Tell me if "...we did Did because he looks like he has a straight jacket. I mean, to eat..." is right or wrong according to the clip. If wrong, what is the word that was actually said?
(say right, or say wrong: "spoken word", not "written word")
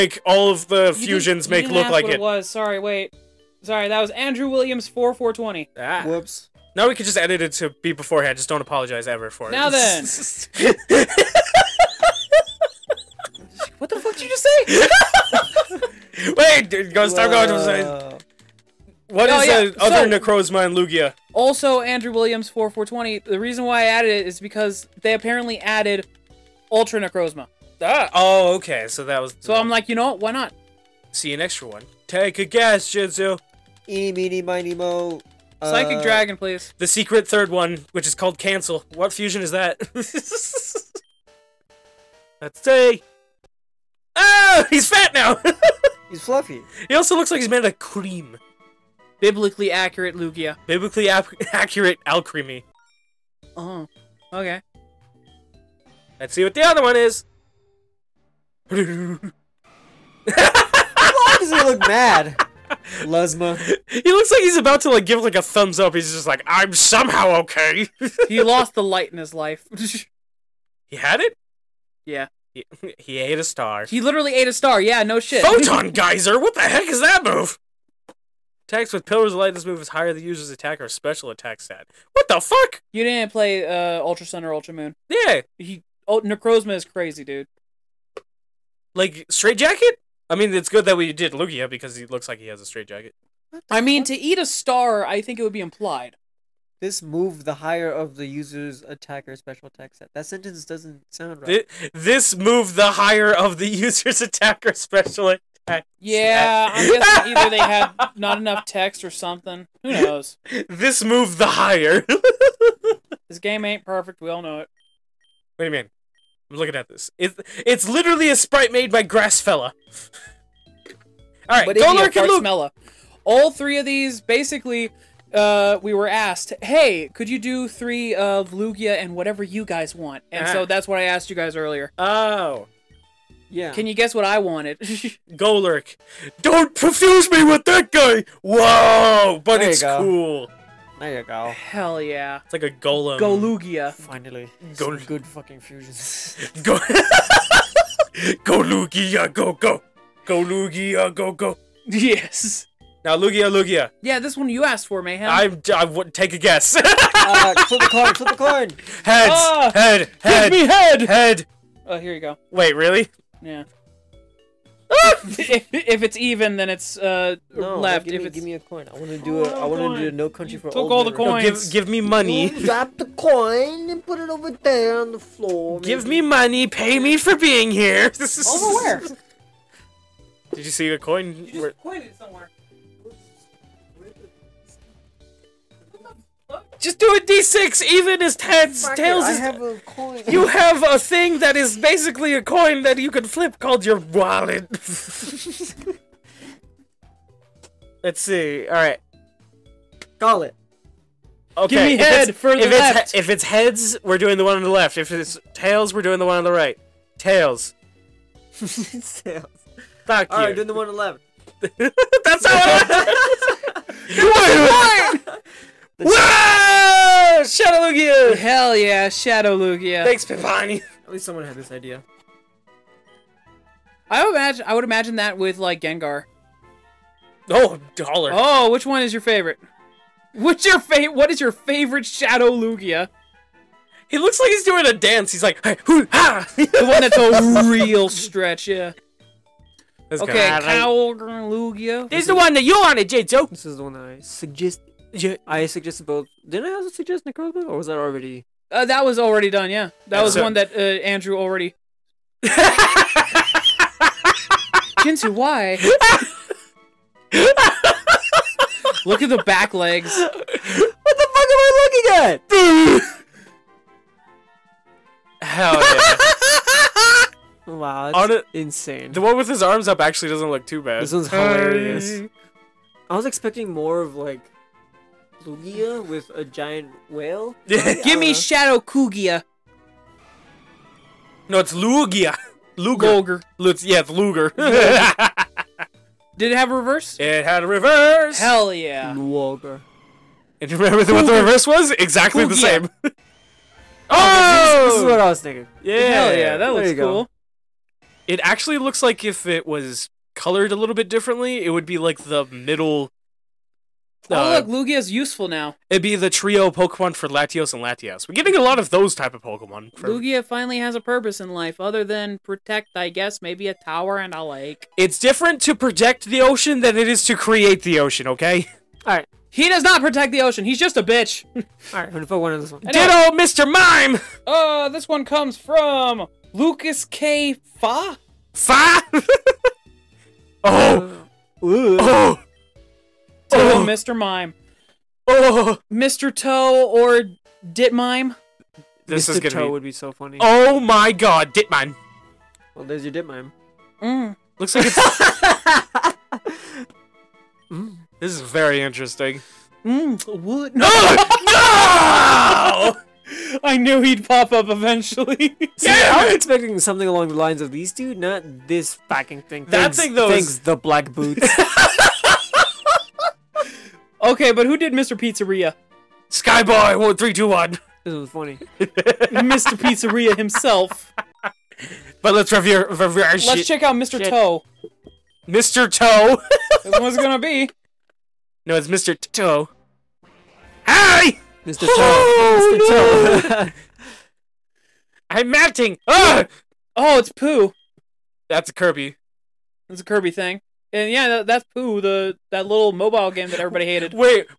wrong: "Lugia", not "Did".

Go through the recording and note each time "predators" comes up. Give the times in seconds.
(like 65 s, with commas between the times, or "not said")
not said.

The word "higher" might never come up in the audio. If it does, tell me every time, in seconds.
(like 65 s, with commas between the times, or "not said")
79 s, 97 s, 102 s, 111 s.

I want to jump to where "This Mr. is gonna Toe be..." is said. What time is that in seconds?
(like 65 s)
339 s.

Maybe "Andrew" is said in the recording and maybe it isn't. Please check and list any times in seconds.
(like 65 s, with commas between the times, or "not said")
4 s, 21 s, 250 s.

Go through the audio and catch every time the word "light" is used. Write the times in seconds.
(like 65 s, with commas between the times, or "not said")
68 s, 79 s.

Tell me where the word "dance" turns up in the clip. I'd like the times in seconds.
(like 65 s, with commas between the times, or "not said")
234 s.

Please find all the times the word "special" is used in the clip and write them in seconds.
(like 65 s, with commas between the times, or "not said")
80 s, 99 s, 104 s.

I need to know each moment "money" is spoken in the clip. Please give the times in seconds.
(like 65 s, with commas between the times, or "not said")
172 s, 176 s.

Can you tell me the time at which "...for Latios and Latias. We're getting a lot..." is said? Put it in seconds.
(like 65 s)
307 s.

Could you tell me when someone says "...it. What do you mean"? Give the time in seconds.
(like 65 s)
114 s.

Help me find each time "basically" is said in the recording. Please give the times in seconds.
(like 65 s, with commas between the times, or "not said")
124 s, 191 s.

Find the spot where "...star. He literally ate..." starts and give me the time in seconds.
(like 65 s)
73 s.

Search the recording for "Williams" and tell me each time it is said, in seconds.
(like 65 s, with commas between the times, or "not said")
4 s, 22 s.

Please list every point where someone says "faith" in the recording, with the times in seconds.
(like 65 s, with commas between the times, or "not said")
not said.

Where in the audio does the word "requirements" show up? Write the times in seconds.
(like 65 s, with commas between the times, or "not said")
not said.